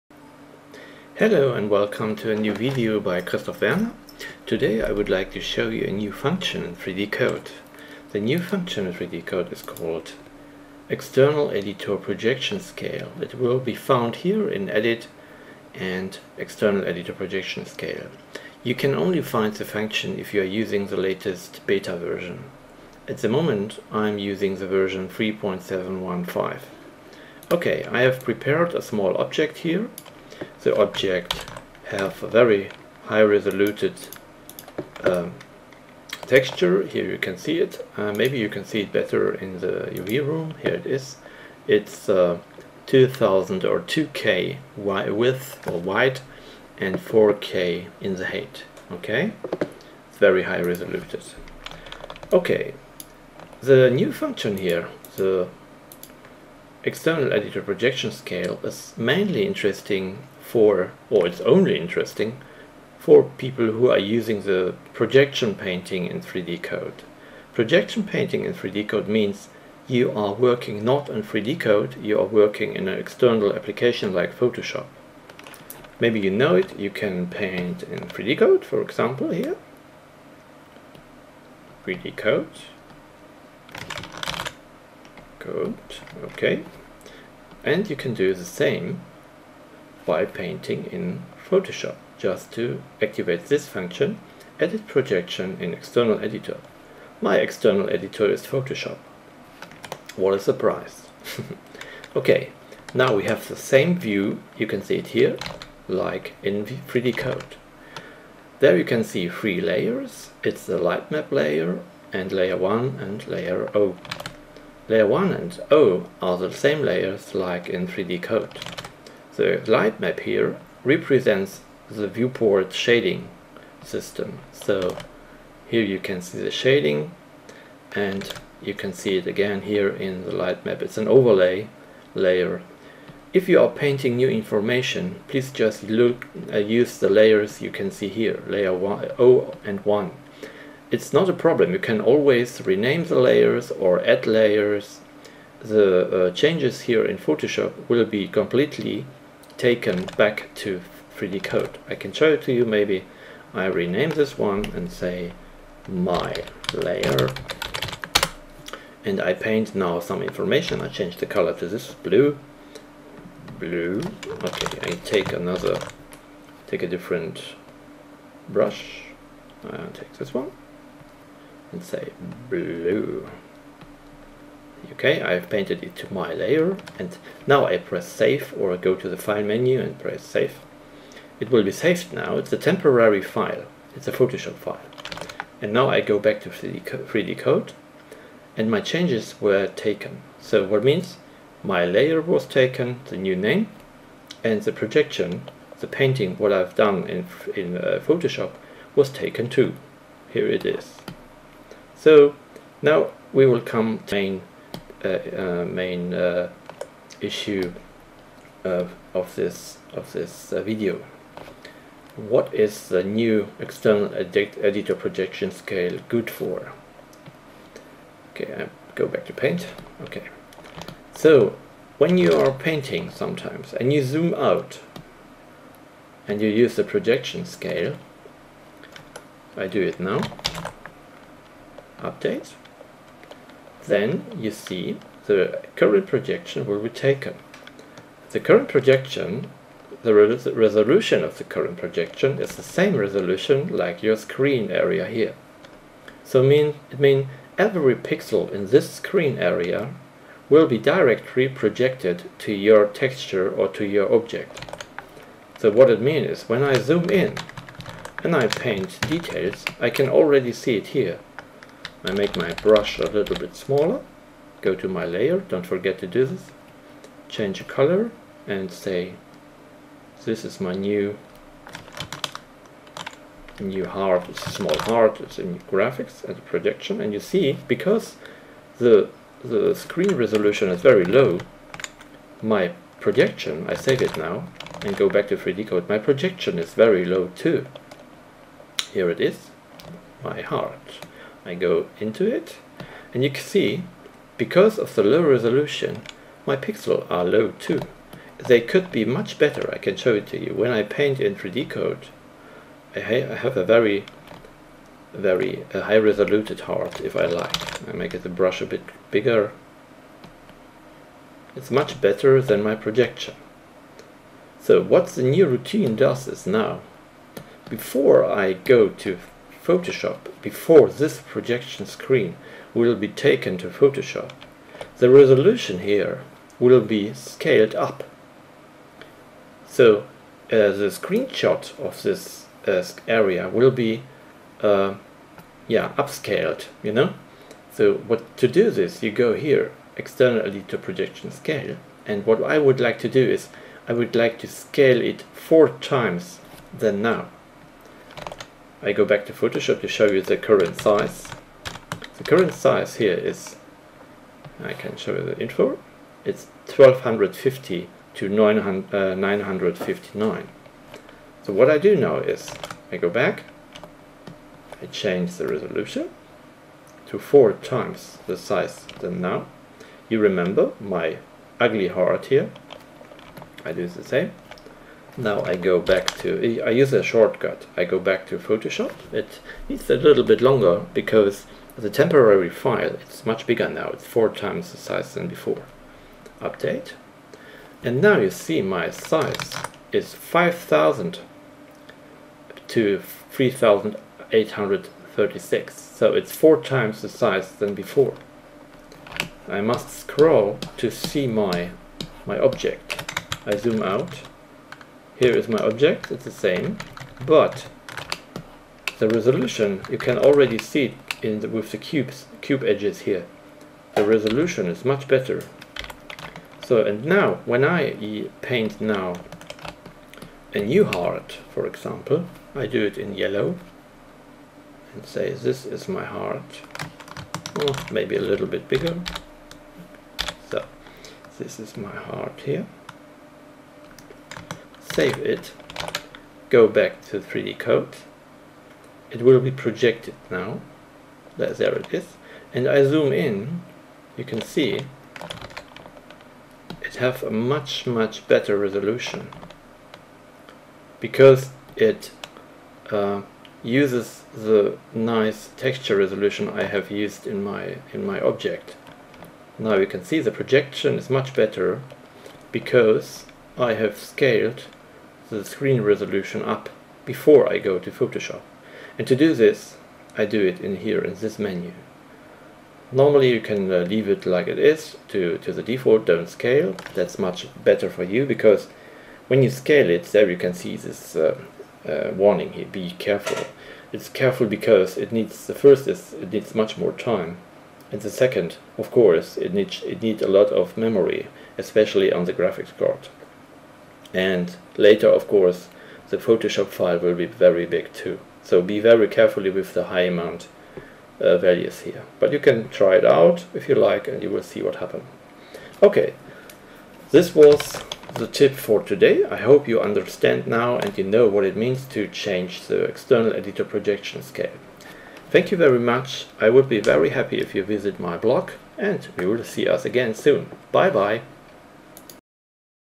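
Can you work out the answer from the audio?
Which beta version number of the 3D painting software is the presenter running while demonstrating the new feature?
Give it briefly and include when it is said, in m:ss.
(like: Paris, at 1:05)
3.715, at 0:25.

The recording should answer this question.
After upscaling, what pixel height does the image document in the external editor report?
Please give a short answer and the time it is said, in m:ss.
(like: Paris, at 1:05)
3,836, at 6:33.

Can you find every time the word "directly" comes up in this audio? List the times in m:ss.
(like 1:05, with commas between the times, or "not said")
4:10.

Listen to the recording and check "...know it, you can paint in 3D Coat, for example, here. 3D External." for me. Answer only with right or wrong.
wrong.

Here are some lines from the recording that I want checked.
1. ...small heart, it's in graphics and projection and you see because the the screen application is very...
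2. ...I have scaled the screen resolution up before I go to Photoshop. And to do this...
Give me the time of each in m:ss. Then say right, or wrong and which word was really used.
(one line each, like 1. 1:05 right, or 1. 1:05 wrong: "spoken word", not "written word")
1. 4:34 wrong: "resolution", not "application"
2. 7:43 right.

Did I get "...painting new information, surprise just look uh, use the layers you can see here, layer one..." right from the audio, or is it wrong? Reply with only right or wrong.
wrong.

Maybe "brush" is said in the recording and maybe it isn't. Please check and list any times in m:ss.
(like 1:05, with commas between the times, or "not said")
2:48, 4:22, 5:08.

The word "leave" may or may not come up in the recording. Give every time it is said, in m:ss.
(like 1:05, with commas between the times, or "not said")
7:53.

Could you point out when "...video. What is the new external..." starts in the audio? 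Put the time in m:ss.
3:30.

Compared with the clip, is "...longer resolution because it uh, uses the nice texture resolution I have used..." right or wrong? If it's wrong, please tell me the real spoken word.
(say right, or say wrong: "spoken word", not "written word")
wrong: "better", not "longer".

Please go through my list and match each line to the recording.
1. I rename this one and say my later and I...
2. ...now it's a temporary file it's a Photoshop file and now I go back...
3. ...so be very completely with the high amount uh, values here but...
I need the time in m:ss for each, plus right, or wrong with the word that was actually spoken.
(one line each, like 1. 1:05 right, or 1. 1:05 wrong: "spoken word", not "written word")
1. 2:33 wrong: "layer", not "later"
2. 3:02 right
3. 8:18 wrong: "carefully", not "completely".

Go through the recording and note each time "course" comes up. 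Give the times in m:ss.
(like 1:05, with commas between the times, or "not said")
8:08, 8:15.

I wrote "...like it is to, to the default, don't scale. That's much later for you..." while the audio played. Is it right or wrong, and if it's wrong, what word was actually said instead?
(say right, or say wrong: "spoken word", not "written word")
wrong: "better", not "later".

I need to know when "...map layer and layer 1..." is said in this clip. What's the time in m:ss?
1:51.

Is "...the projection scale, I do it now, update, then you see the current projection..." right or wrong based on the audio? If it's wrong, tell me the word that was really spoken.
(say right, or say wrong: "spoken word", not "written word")
right.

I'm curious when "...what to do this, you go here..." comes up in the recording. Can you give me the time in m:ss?
5:38.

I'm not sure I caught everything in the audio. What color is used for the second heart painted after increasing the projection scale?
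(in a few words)
yellow.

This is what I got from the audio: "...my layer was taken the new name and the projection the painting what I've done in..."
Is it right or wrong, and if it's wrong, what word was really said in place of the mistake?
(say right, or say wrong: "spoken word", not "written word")
right.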